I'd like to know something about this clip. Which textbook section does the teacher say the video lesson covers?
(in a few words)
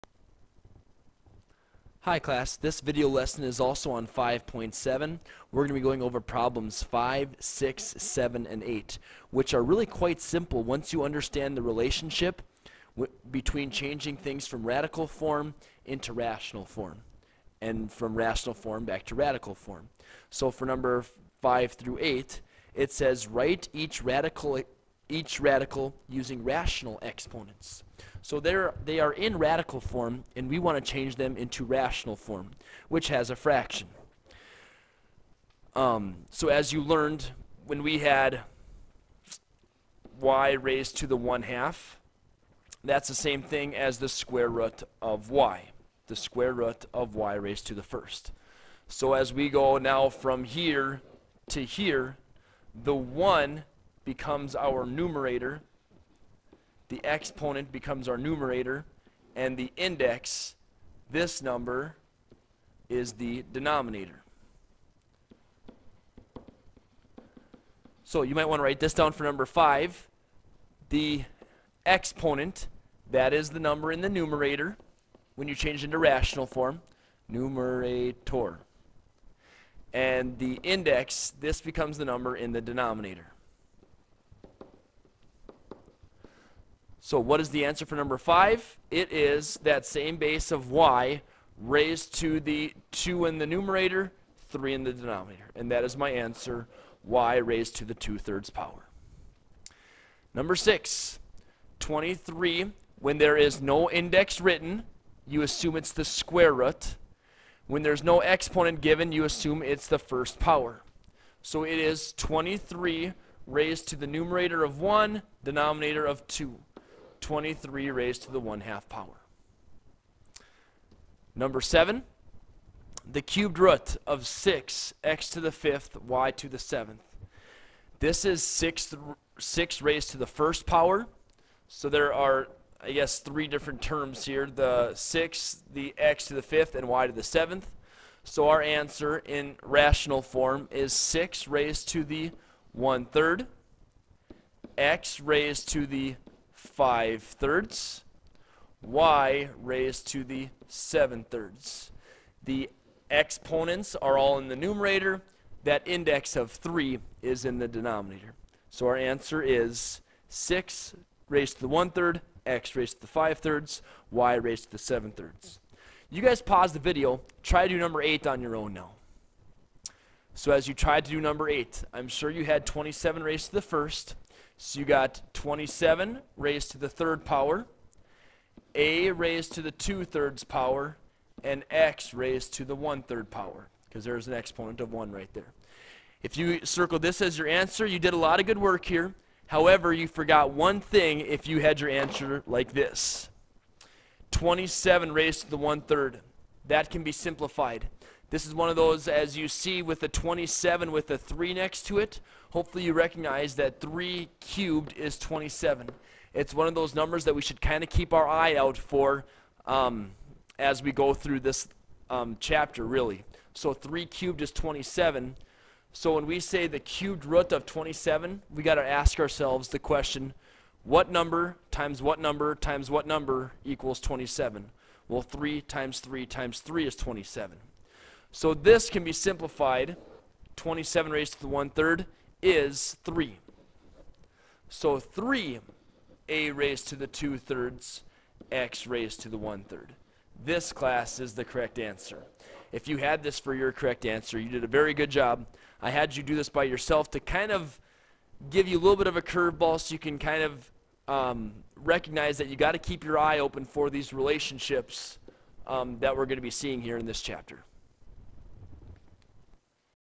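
5.7.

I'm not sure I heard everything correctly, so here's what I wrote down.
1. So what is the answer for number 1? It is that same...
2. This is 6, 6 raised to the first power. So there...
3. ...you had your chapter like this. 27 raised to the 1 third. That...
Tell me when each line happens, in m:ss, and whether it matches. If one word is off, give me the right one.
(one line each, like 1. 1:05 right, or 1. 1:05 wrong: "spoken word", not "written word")
1. 1:27 wrong: "5", not "1"
2. 2:07 right
3. 3:11 wrong: "answer", not "chapter".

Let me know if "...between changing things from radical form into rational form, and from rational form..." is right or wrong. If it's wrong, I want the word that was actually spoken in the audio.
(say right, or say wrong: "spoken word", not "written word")
right.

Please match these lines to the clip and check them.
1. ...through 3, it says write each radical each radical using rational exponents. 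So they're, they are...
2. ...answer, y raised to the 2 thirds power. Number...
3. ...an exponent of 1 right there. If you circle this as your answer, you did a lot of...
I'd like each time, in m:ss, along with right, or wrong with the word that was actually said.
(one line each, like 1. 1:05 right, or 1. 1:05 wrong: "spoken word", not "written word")
1. 0:21 wrong: "8", not "3"
2. 1:36 right
3. 3:04 right.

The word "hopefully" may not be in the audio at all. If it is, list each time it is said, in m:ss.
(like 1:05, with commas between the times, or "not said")
3:22.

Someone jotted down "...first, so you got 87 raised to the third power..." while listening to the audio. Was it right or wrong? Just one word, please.
wrong.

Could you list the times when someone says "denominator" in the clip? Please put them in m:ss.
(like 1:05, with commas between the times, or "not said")
1:03, 1:22, 1:34, 1:55, 2:37.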